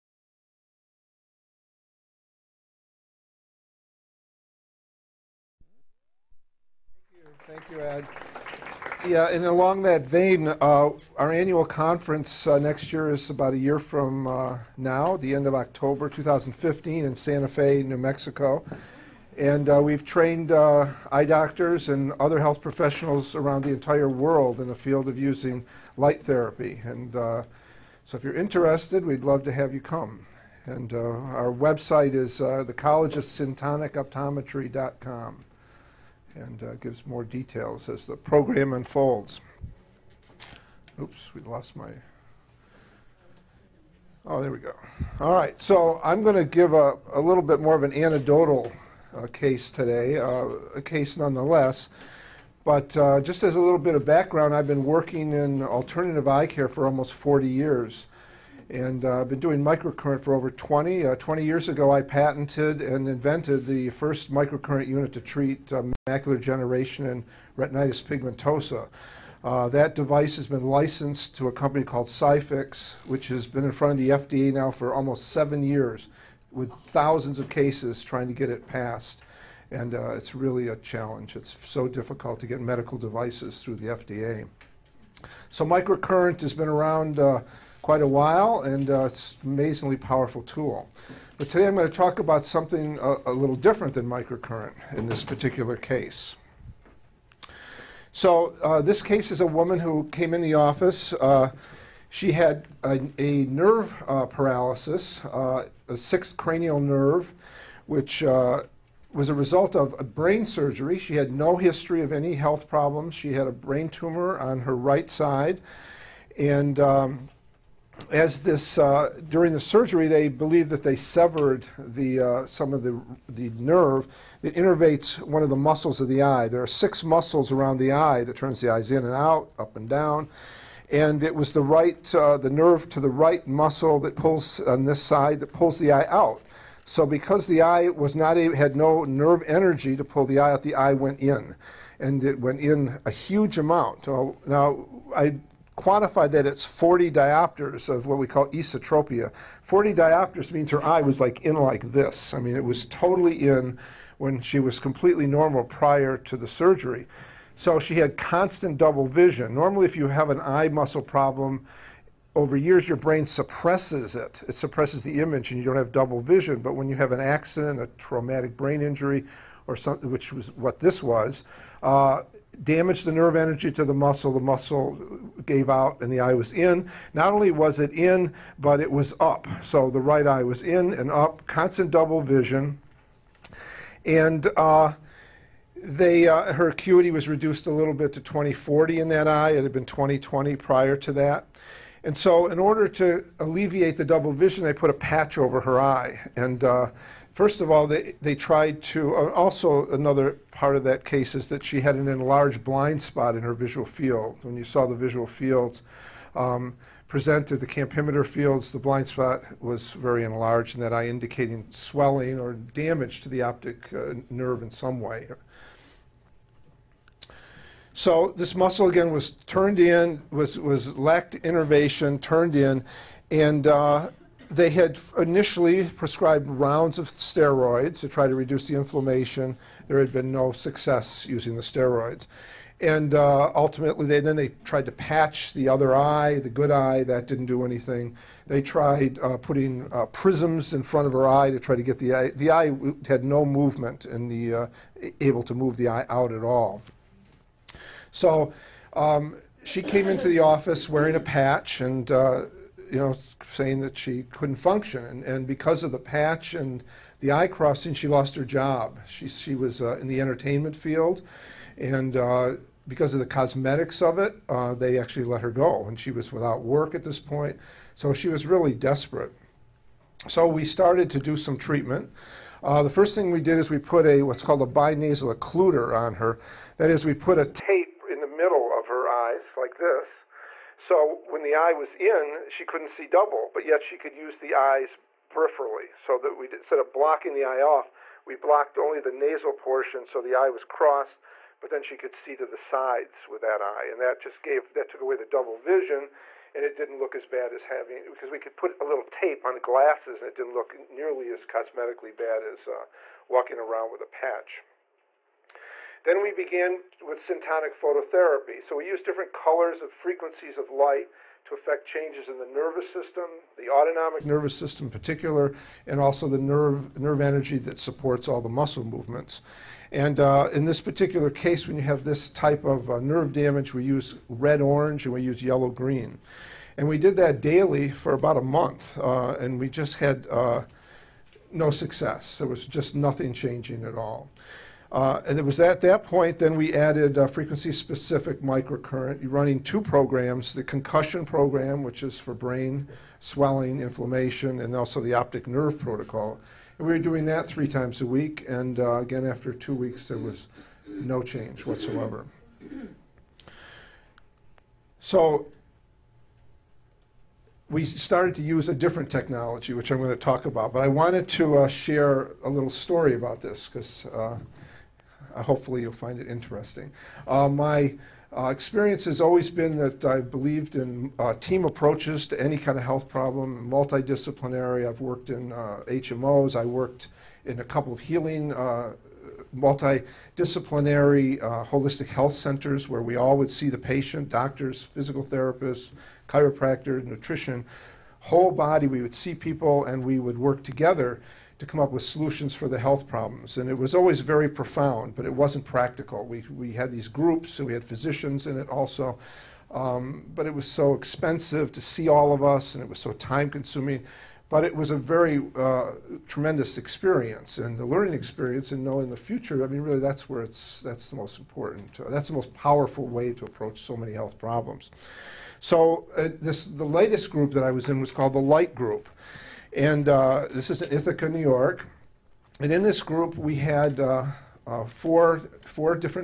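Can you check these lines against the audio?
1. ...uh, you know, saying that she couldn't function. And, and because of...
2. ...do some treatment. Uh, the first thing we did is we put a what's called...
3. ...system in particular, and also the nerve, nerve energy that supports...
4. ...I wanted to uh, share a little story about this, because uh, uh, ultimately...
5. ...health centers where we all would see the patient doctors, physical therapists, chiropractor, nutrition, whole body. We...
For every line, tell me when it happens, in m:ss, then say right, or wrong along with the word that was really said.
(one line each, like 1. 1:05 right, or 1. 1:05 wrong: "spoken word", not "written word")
1. 4:12 right
2. 4:31 right
3. 5:14 right
4. 6:00 wrong: "hopefully", not "ultimately"
5. 6:22 right.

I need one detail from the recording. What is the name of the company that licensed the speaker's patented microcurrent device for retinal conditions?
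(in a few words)
ScyFIX.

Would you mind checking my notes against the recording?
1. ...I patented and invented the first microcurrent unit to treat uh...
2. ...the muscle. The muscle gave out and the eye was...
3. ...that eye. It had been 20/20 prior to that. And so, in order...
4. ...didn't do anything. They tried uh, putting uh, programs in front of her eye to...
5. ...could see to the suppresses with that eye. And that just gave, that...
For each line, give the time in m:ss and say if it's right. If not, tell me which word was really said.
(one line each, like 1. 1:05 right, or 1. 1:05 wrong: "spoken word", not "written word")
1. 1:01 right
2. 2:53 right
3. 3:09 right
4. 3:57 wrong: "prisms", not "programs"
5. 4:51 wrong: "sides", not "suppresses".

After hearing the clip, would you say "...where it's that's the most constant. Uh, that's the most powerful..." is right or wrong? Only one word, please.
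wrong.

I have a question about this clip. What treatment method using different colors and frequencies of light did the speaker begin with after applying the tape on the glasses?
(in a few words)
syntonic phototherapy.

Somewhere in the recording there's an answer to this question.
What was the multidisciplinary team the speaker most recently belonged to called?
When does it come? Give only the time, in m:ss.
6:58.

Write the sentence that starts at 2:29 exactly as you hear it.
40 diopters means her eye was like in like this.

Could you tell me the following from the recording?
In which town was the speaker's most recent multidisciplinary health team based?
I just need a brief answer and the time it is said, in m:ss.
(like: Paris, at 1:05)
Ithaca, at 7:00.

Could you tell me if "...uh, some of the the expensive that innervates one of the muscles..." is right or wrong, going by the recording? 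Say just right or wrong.
wrong.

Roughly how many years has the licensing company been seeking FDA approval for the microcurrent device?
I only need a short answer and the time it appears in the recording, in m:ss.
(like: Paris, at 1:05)
7, at 1:15.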